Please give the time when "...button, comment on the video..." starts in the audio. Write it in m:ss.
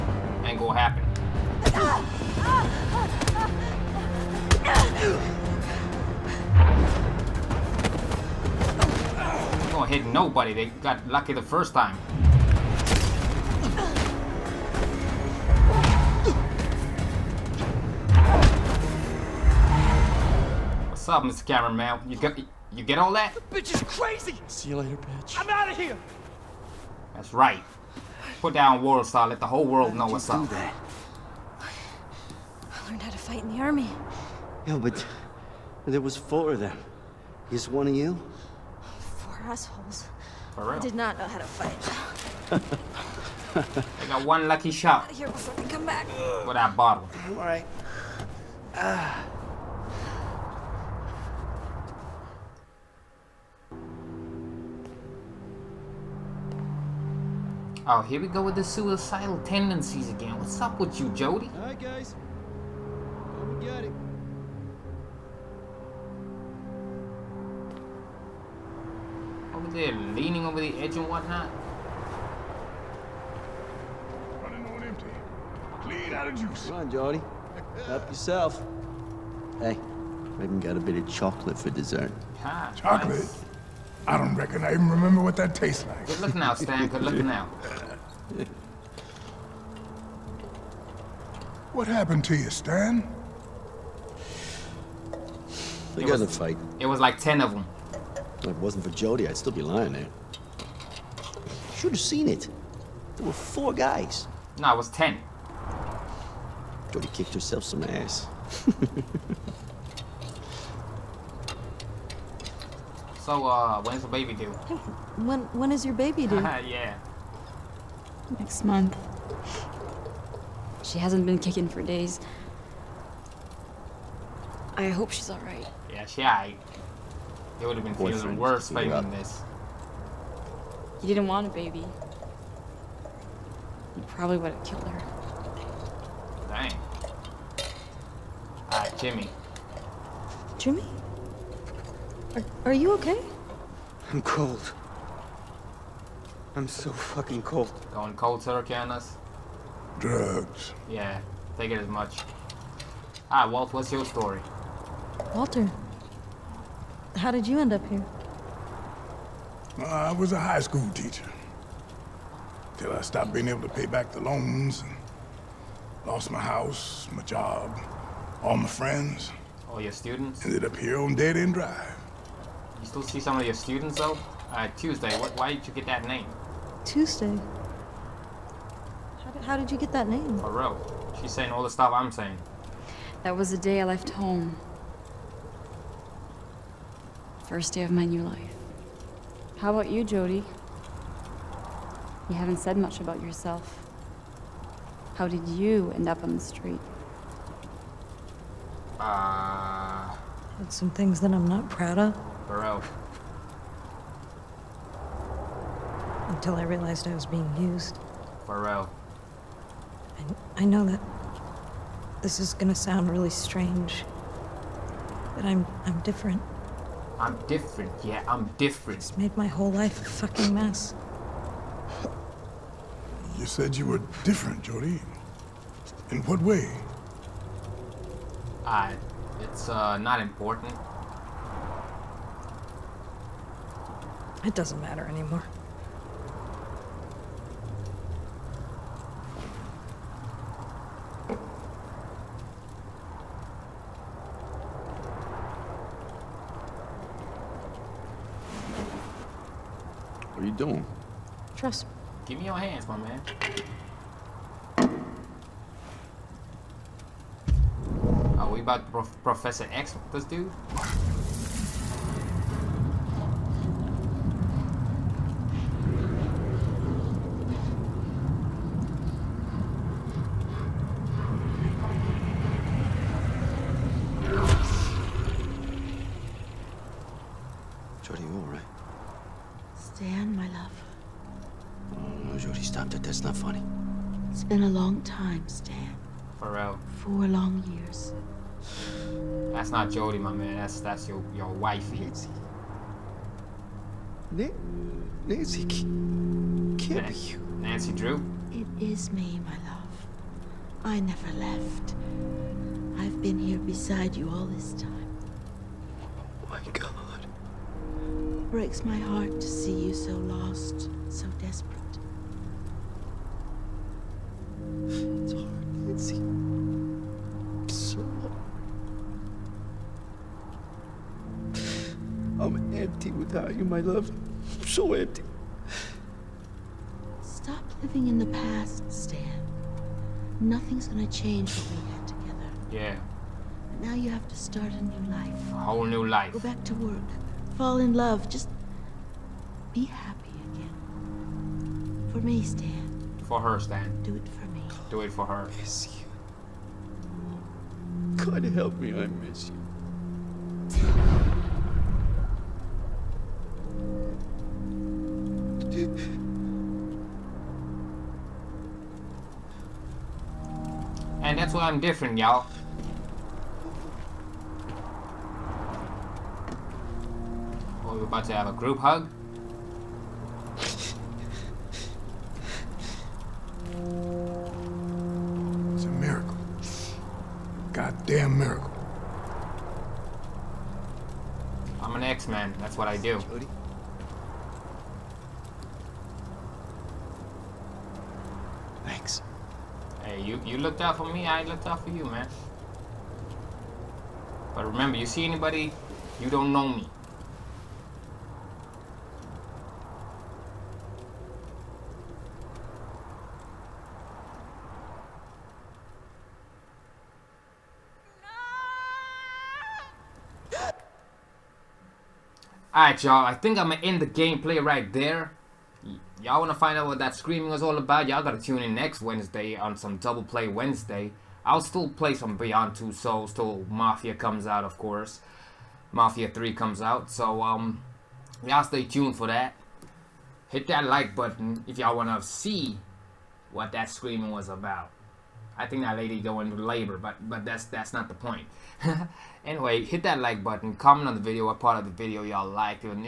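7:20.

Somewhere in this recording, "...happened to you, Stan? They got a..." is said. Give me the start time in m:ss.
1:31.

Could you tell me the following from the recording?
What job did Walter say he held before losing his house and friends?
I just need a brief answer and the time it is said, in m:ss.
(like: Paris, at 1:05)
high school teacher, at 2:40.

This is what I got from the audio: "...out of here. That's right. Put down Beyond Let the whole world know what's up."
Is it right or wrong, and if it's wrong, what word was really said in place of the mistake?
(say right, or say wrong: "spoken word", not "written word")
wrong: "World", not "Beyond".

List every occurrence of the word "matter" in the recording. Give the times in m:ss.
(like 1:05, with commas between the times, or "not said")
3:54.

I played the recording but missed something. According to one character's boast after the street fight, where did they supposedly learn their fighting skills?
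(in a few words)
the army.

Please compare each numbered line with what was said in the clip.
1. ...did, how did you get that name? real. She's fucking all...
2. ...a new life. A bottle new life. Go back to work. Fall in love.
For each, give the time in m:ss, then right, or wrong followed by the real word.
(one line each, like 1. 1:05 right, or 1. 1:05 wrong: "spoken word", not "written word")
1. 2:59 wrong: "saying", not "fucking"
2. 5:34 wrong: "whole", not "bottle".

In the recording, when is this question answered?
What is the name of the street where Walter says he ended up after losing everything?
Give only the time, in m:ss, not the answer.
2:51.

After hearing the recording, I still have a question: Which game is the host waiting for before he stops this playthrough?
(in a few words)
Mafia 3.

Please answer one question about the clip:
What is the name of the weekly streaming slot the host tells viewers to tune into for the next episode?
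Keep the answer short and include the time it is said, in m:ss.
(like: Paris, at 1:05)
Double Play Wednesday, at 6:59.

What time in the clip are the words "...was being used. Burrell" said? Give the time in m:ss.
3:27.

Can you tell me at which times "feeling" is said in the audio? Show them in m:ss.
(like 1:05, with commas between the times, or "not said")
2:07.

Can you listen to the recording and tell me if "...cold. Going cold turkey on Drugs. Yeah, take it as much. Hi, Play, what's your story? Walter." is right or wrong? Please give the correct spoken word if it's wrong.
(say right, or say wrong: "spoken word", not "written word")
wrong: "Walt", not "Play".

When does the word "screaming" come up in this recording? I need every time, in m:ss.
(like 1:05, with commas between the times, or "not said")
6:57, 7:13.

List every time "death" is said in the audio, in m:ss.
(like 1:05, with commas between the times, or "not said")
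not said.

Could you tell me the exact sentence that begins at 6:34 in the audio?
But remember, you see anybody, you don't know me.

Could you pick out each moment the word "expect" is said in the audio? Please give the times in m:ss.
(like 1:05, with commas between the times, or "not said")
not said.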